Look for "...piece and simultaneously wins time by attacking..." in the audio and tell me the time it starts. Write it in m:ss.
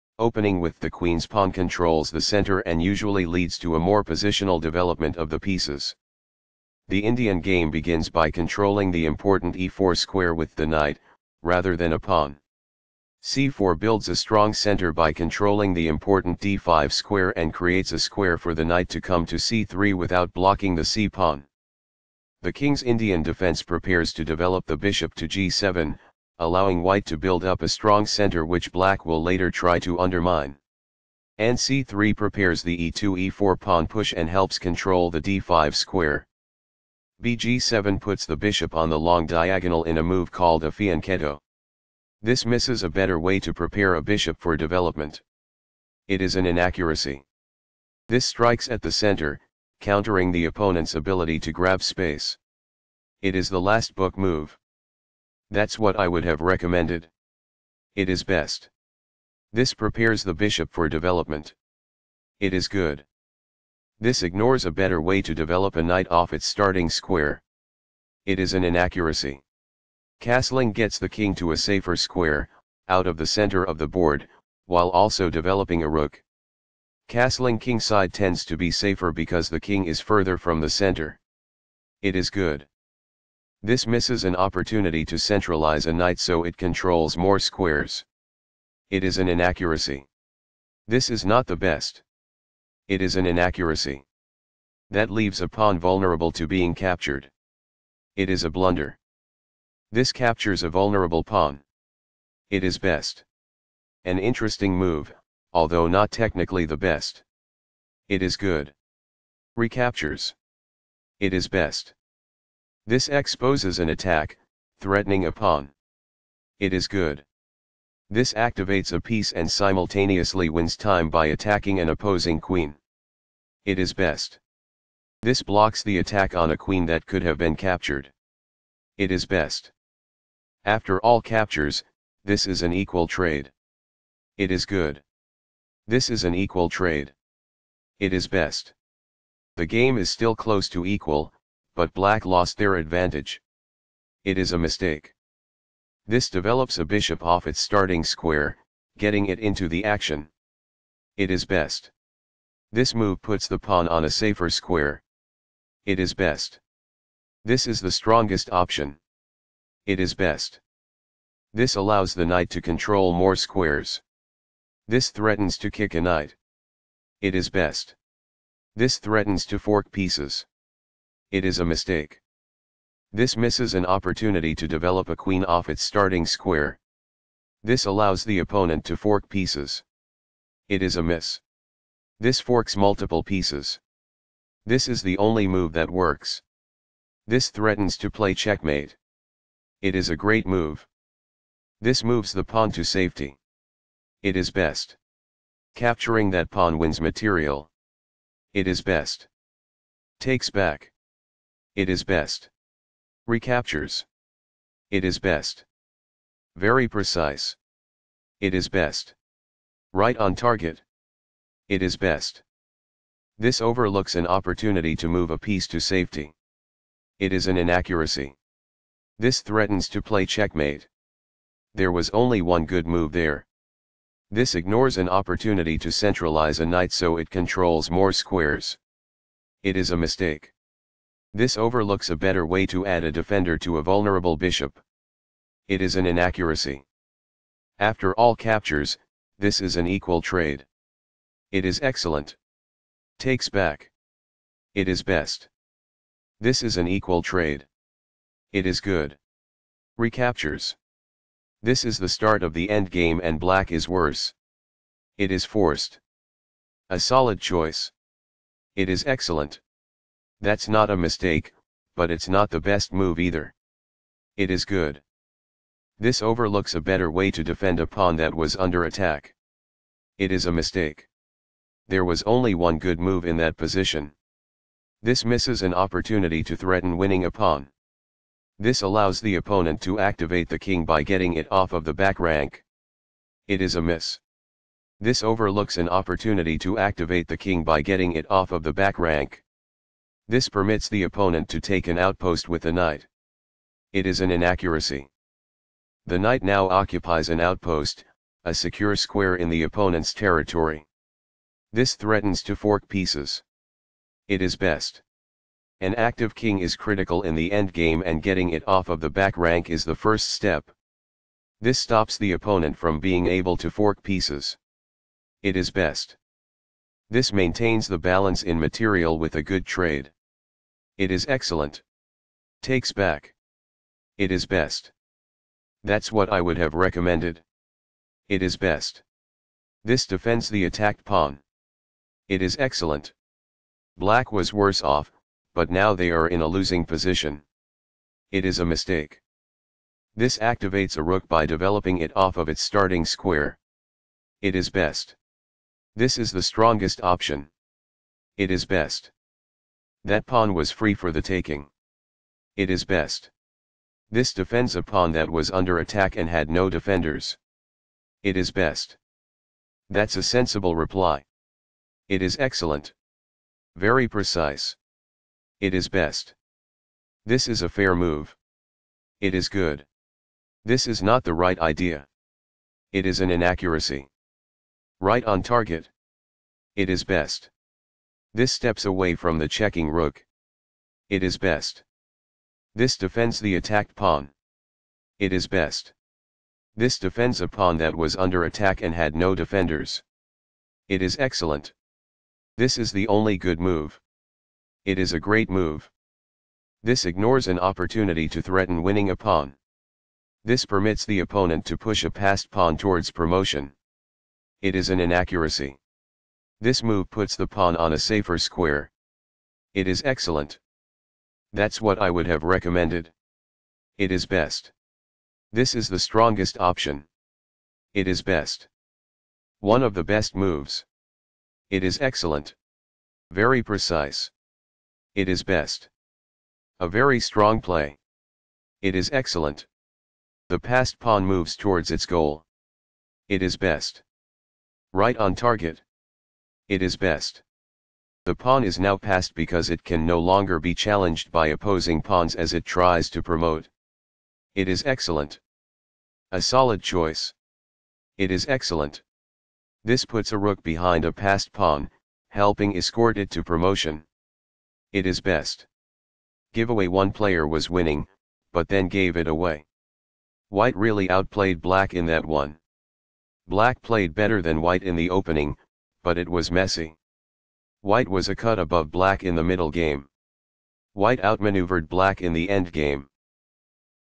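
1:58.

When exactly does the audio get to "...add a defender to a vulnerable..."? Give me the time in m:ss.
3:52.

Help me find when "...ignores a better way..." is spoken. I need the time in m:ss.
1:04.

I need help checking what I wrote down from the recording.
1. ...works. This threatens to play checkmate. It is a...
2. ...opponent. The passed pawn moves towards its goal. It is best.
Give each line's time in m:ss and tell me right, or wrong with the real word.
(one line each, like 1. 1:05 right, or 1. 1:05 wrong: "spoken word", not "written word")
1. 3:05 right
2. 7:09 wrong: "excellent", not "opponent".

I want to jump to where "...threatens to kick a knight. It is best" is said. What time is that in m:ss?
2:45.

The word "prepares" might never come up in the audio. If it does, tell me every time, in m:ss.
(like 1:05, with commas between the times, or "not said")
0:23, 0:32, 0:43, 0:59.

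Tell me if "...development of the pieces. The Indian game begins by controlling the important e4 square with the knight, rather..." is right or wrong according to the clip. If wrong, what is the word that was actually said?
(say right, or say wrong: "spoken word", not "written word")
right.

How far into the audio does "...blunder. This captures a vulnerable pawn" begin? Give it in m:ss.
1:38.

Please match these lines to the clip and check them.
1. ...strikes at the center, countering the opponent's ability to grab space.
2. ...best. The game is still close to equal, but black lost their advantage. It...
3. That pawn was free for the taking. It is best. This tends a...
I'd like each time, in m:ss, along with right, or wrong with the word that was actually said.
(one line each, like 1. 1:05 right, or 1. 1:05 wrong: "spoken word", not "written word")
1. 0:48 right
2. 2:18 right
3. 5:50 wrong: "defends", not "tends".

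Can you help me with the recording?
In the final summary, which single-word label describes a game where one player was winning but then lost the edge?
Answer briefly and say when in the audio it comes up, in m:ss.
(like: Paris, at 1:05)
Giveaway, at 7:36.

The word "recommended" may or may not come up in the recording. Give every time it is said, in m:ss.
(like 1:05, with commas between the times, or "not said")
0:56, 5:26, 6:52.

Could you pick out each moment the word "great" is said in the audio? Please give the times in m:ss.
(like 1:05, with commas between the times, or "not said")
3:10, 6:35.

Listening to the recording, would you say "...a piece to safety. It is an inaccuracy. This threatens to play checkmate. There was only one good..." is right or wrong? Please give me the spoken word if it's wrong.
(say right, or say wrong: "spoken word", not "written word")
right.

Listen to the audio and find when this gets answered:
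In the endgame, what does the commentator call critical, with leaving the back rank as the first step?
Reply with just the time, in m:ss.
5:05.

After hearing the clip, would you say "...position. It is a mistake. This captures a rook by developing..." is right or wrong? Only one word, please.
wrong.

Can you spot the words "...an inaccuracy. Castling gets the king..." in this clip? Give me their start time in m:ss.
1:08.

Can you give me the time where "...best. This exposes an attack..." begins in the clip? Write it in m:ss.
1:51.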